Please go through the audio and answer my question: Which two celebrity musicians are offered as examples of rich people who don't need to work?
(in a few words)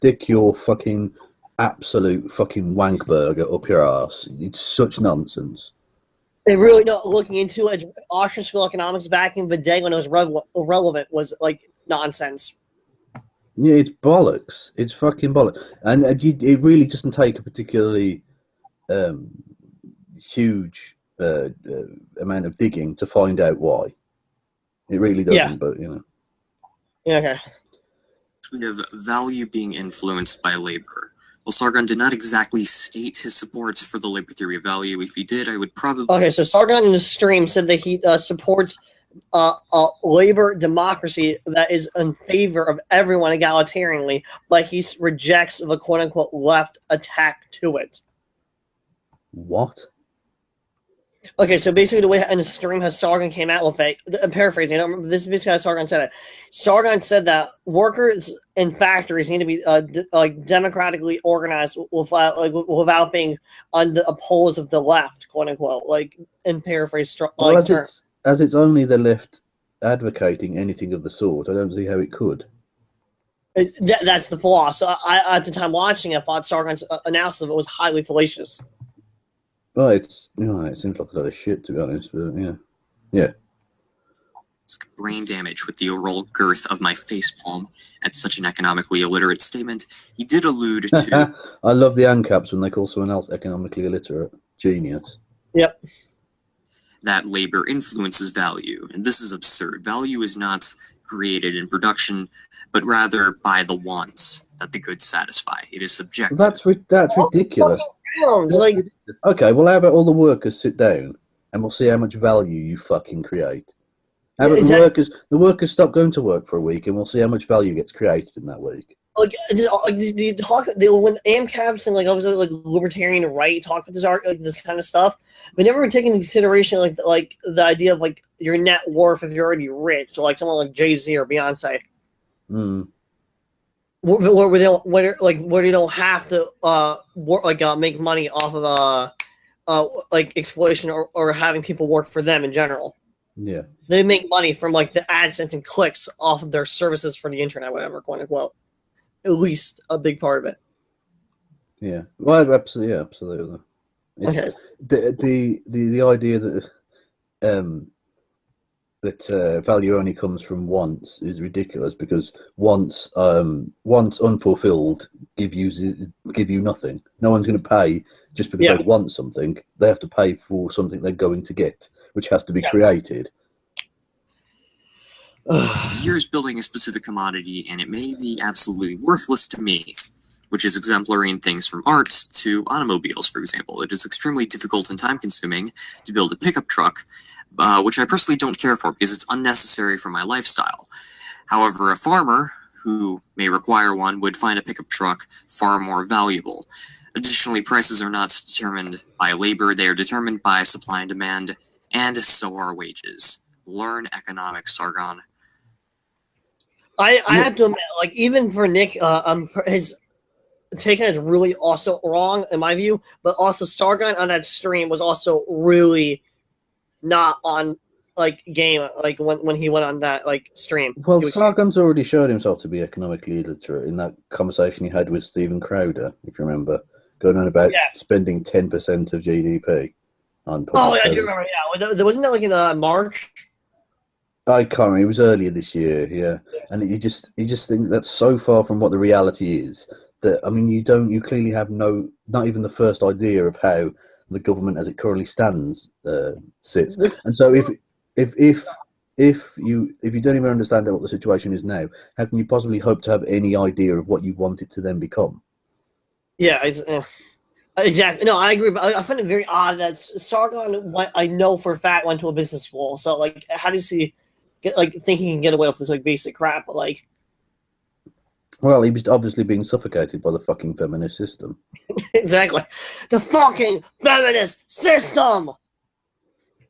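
Jay Z or Beyonce.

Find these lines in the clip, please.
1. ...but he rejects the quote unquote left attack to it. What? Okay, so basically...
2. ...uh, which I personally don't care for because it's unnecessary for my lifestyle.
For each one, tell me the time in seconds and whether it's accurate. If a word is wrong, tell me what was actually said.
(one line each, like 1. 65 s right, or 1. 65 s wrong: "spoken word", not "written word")
1. 44 s right
2. 187 s right.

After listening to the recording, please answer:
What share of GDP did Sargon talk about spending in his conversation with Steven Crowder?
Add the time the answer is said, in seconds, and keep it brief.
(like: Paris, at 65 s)
10 percent, at 228 s.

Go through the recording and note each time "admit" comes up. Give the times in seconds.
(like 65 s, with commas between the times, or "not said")
207 s.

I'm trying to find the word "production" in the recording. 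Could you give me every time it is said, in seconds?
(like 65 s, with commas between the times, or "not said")
101 s.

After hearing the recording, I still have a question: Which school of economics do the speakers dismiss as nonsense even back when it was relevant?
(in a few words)
Austrian school.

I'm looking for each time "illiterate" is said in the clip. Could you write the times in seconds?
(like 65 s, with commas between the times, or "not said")
89 s, 93 s, 223 s.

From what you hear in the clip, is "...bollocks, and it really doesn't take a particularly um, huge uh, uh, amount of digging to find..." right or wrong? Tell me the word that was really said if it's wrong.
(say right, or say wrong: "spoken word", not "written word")
right.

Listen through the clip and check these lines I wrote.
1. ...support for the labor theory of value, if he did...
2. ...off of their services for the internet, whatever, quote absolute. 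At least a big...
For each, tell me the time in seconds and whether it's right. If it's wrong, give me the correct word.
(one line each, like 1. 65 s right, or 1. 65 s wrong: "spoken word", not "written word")
1. 33 s right
2. 146 s wrong: "unquote", not "absolute".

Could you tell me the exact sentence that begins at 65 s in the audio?
Like in paraphrase, like, well, as, term.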